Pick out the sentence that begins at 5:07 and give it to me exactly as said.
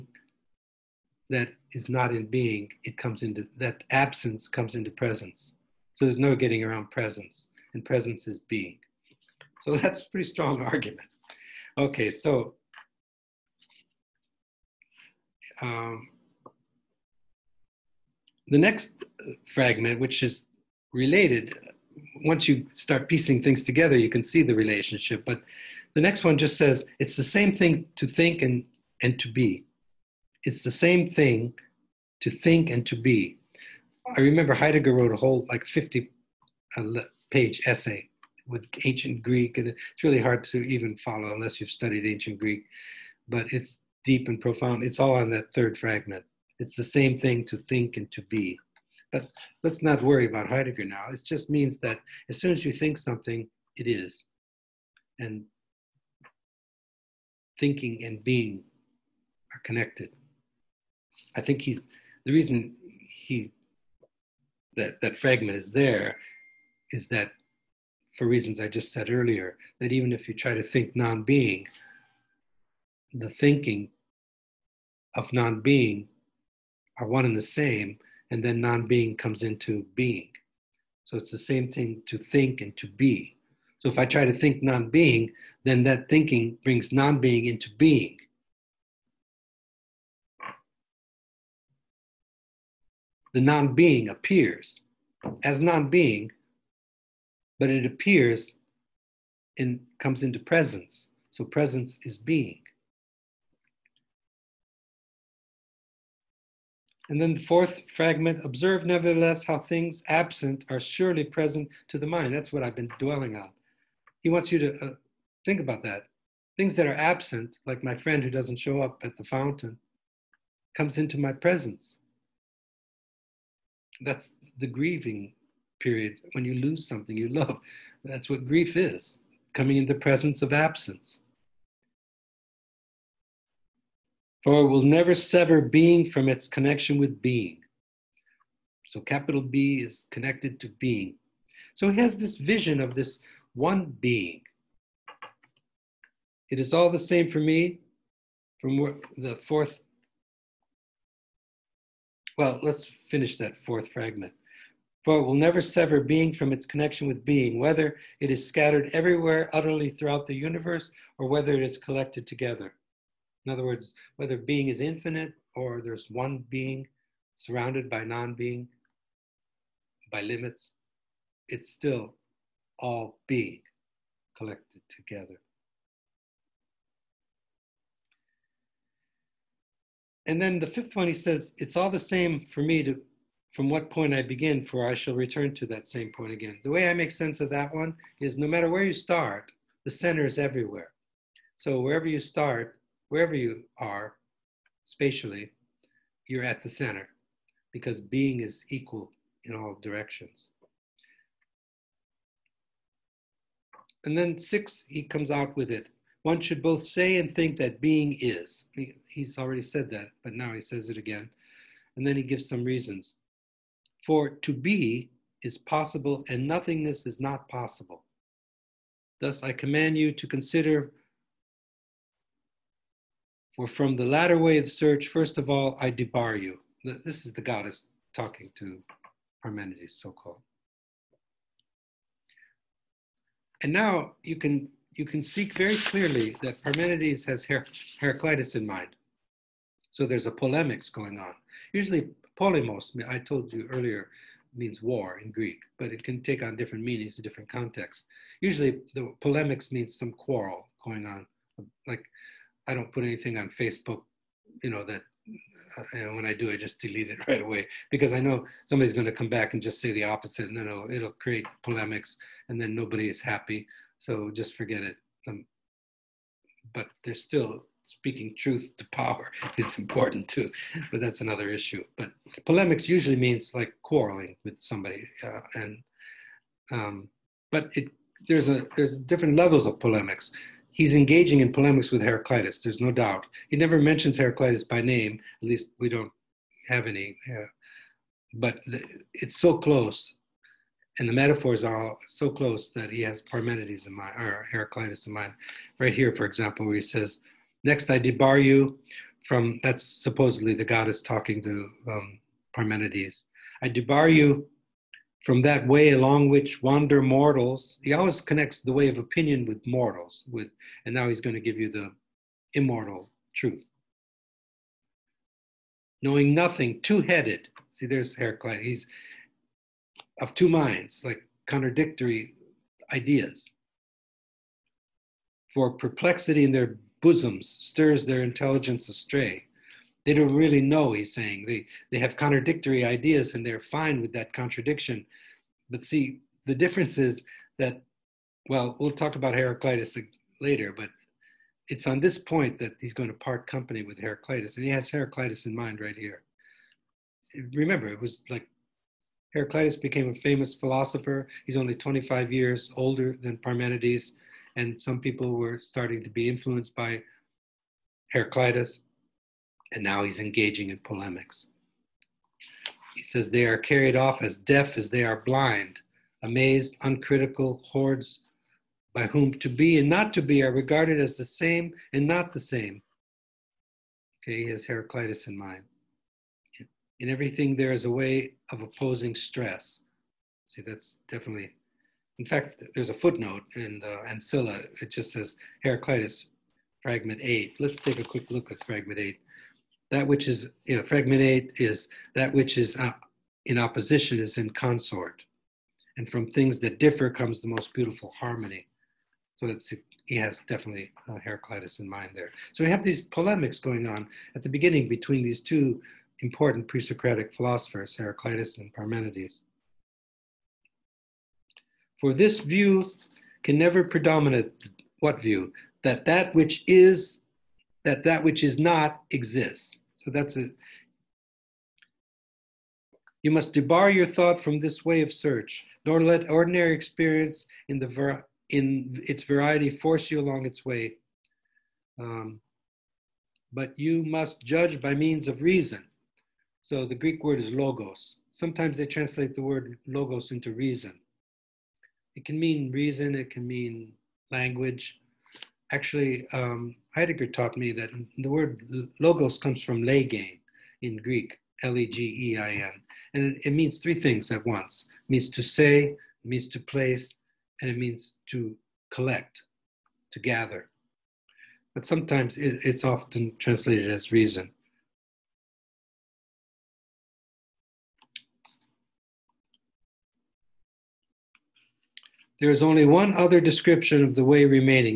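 He always connects the way of opinion with mortals, with, and now he's going to give you the immortal truth.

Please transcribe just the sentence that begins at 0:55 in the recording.
And thinking and being are connected.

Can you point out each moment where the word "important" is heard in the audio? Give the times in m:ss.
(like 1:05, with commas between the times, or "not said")
4:29, 6:46.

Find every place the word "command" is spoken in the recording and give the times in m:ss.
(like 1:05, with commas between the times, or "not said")
3:39.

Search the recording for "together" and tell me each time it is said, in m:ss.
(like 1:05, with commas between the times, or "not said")
0:23, 2:42, 2:54.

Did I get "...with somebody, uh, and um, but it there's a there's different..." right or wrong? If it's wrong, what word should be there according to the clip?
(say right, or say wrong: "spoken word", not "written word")
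right.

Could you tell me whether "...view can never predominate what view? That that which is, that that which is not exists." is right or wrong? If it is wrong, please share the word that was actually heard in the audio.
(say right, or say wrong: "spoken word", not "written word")
right.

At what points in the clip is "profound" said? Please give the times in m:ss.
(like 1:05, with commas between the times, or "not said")
0:44.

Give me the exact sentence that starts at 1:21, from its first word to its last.
So it's the same thing to think and to be.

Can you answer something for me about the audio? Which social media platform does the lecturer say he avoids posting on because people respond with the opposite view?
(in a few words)
Facebook.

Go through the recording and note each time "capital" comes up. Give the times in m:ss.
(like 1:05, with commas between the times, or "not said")
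2:19.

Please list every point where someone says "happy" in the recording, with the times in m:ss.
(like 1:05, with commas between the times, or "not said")
4:23.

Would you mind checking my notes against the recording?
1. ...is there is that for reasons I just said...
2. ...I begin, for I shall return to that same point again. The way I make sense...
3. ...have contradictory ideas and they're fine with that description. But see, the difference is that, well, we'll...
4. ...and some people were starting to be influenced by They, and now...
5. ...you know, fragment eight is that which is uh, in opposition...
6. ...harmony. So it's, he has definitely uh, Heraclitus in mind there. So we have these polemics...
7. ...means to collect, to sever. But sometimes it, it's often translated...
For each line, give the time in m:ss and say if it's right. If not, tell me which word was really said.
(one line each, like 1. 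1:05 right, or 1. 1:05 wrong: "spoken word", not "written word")
1. 1:05 right
2. 3:04 right
3. 5:31 wrong: "contradiction", not "description"
4. 5:54 wrong: "Heraclitus", not "They"
5. 6:30 right
6. 6:38 right
7. 7:37 wrong: "gather", not "sever".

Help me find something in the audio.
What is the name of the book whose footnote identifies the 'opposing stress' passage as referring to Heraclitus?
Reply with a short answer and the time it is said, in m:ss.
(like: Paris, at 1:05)
Ancilla, at 6:24.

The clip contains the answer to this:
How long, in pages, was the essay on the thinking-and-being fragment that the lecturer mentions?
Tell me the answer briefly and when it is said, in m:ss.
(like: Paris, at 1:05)
50, at 0:35.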